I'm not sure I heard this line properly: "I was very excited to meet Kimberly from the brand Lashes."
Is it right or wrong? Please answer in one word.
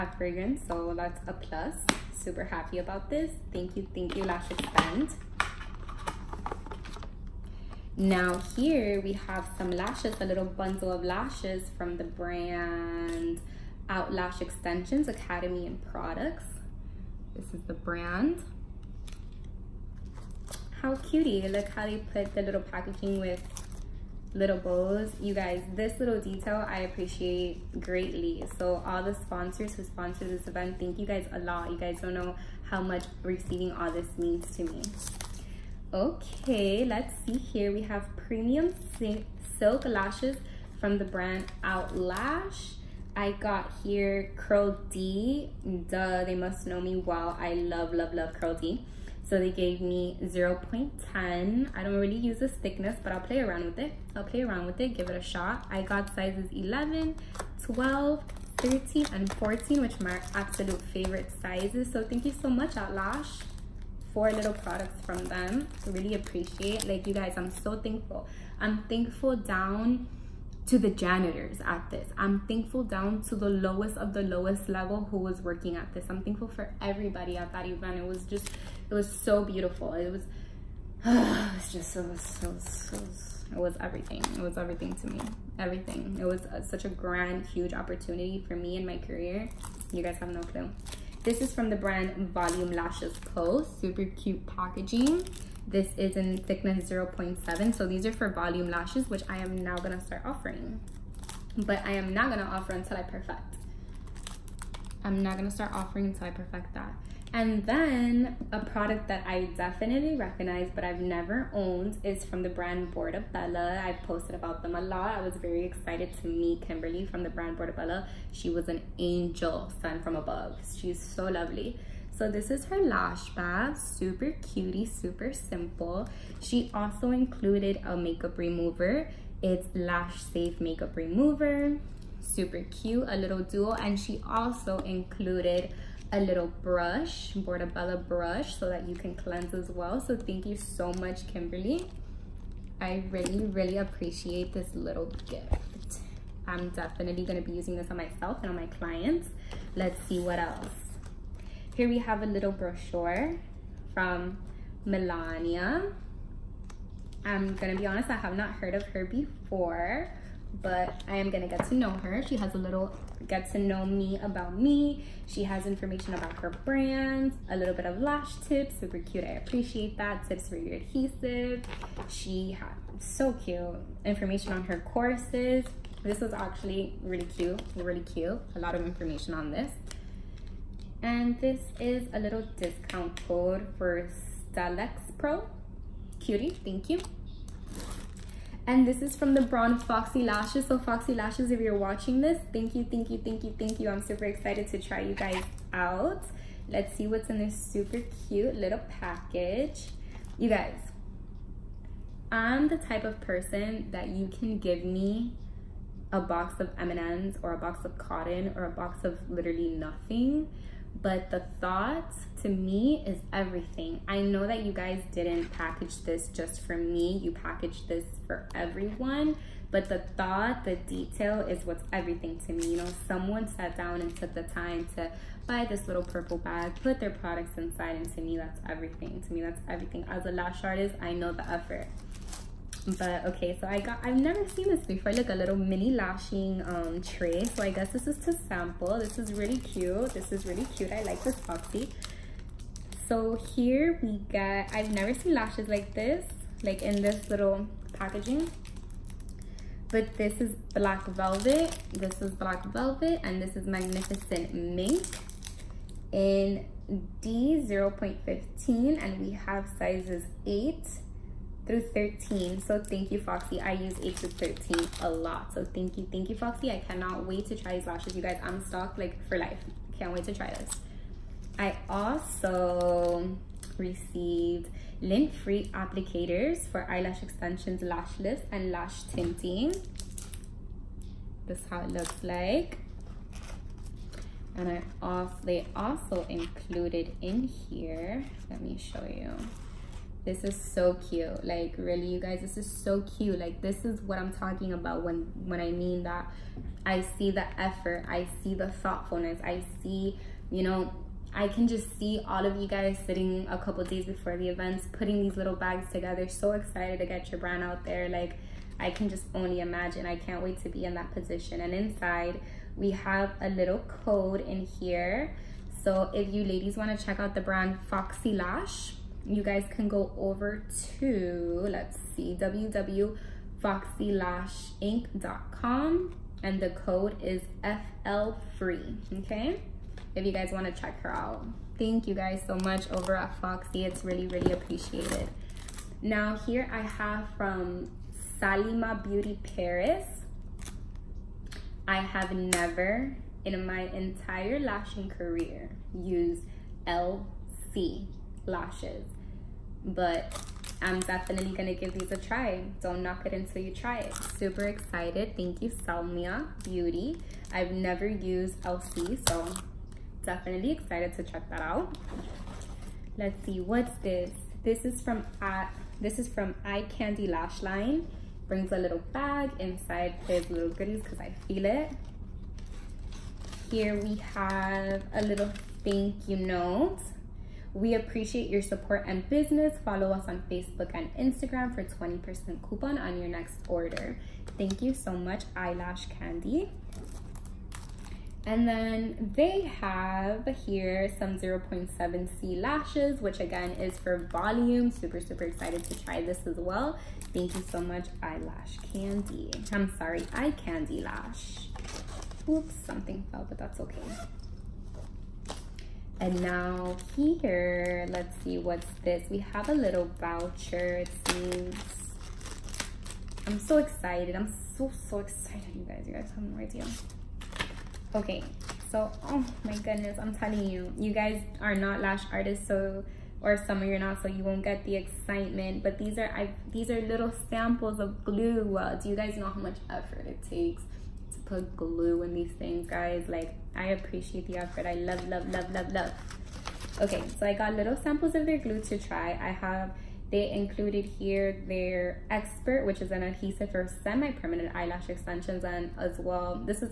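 wrong.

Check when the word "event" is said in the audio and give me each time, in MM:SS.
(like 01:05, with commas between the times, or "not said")
00:30, 01:17, 05:04.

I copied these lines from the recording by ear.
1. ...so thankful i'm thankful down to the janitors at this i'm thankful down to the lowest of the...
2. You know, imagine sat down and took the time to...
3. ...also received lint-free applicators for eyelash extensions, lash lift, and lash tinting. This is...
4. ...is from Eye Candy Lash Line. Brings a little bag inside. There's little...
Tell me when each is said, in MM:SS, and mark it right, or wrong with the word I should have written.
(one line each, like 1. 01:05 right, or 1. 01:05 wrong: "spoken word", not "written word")
1. 01:07 right
2. 03:42 wrong: "someone", not "imagine"
3. 04:31 right
4. 06:06 right.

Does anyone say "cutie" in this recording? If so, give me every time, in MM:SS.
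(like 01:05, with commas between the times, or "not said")
00:20, 02:04, 03:06.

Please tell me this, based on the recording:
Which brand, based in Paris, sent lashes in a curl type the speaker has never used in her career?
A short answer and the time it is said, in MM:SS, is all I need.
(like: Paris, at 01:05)
Salima Beauty Paris, at 05:38.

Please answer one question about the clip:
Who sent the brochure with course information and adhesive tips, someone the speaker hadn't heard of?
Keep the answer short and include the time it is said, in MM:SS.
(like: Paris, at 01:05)
Melania, at 02:34.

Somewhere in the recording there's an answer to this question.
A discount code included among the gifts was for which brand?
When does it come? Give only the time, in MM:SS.
03:04.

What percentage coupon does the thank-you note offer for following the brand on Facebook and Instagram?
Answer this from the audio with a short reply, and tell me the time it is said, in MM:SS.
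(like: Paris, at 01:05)
20%, at 06:21.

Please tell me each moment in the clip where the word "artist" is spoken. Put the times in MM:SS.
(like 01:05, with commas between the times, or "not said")
03:50, 07:02.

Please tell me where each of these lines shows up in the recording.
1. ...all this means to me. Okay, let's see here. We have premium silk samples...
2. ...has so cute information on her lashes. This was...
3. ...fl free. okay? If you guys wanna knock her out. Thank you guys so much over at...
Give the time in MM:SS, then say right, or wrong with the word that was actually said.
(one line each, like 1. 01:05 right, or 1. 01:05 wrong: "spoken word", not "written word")
1. 00:33 wrong: "lashes", not "samples"
2. 02:52 wrong: "courses", not "lashes"
3. 05:28 wrong: "check", not "knock".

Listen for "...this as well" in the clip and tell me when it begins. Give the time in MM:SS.
06:36.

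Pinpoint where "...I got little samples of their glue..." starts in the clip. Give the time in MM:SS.
07:17.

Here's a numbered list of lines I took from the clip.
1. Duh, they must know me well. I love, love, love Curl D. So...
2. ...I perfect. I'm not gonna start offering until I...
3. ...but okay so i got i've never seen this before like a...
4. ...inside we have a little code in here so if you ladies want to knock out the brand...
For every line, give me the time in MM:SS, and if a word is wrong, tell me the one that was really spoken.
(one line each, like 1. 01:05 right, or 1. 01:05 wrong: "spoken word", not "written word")
1. 00:45 right
2. 01:42 right
3. 03:52 right
4. 05:11 wrong: "check", not "knock".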